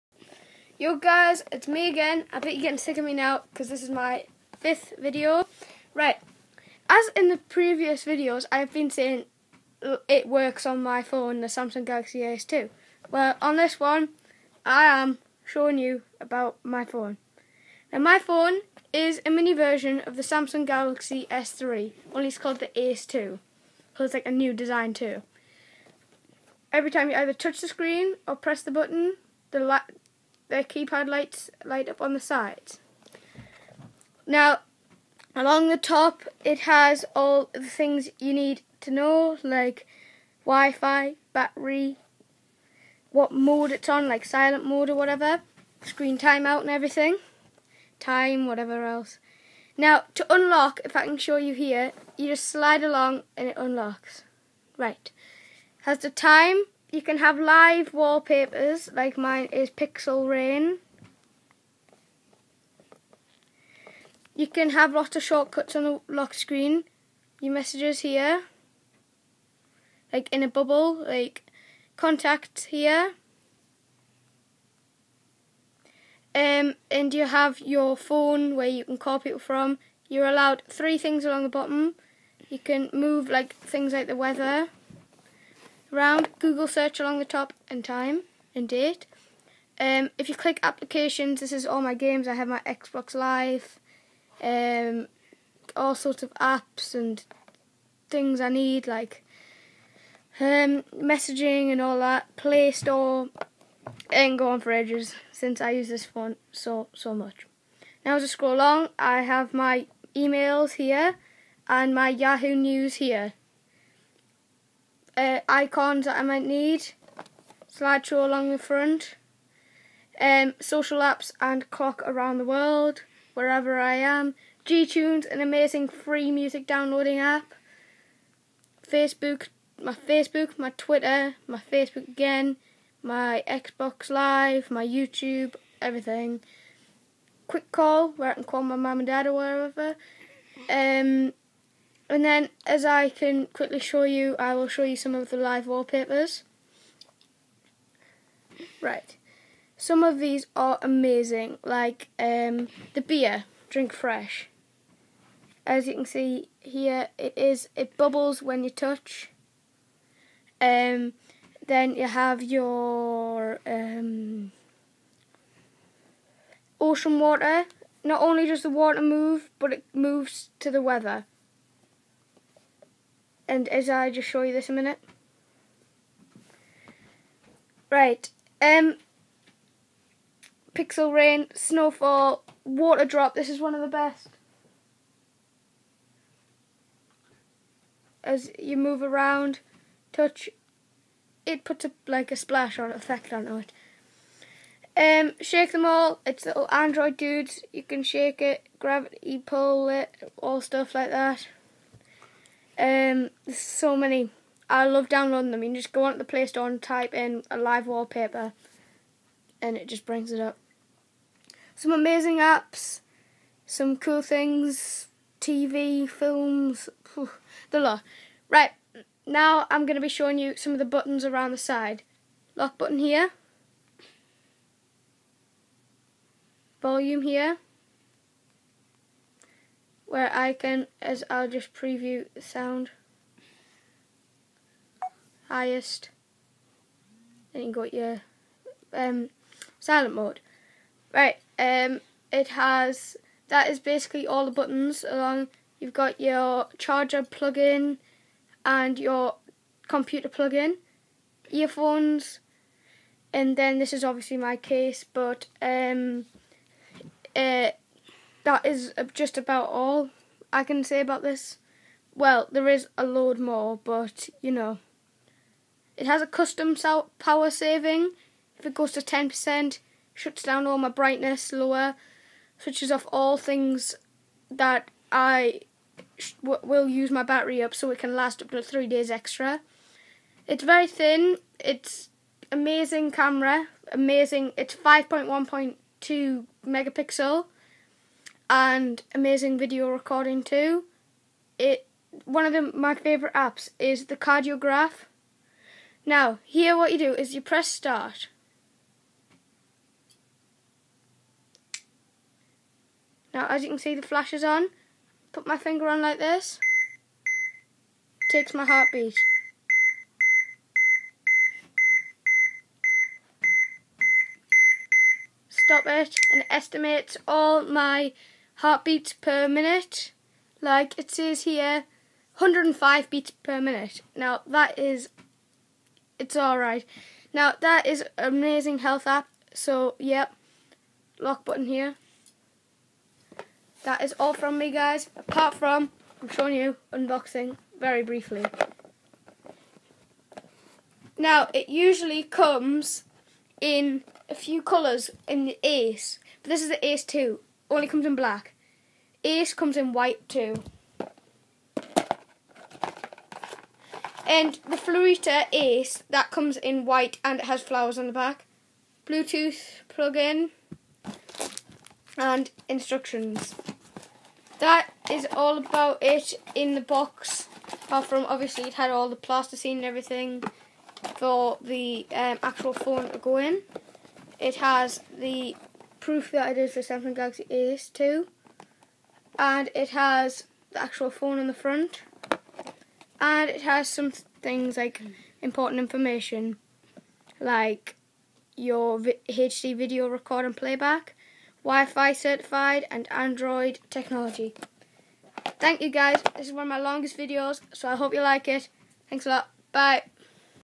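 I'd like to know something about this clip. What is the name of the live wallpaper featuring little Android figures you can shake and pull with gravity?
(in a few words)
Shake Them All.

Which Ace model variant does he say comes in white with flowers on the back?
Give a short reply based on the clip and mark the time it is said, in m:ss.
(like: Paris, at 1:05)
Florita Ace, at 5:54.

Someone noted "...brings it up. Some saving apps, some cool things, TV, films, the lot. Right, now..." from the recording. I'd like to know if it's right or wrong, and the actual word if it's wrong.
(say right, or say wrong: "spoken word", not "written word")
wrong: "amazing", not "saving".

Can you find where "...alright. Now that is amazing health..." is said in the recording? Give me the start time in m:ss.
5:26.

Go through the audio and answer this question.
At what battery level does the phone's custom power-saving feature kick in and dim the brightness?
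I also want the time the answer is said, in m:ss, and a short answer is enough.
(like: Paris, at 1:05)
10%, at 4:29.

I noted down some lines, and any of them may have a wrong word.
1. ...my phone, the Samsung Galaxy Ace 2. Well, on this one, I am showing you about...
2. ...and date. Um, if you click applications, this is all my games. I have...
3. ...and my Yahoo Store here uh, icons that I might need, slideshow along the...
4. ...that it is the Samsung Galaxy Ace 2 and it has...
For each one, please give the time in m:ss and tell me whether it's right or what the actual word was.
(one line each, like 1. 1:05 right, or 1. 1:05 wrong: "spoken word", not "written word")
1. 0:10 right
2. 1:28 right
3. 1:51 wrong: "News", not "Store"
4. 6:16 right.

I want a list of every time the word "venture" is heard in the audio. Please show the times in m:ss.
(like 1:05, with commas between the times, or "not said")
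not said.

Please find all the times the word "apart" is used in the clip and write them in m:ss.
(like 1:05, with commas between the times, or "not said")
5:35, 6:07.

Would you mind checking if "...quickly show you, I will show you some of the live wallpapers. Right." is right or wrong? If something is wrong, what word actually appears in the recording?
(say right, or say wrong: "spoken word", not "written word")
right.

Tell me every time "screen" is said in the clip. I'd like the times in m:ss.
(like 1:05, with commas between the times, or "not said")
0:27, 0:45, 1:06.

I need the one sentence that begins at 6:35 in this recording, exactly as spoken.
Thank you guys, this is one of my longest videos so I hope you like it.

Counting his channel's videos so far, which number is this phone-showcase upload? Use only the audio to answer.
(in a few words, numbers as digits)
Fifth.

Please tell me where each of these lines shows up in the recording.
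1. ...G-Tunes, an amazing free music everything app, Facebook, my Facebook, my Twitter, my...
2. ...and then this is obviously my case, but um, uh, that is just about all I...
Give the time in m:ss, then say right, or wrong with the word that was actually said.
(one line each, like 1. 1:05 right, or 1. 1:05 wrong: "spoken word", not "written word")
1. 2:04 wrong: "downloading", not "everything"
2. 4:13 right.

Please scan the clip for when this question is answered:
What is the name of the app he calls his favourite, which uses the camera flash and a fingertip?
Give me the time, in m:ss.
4:54.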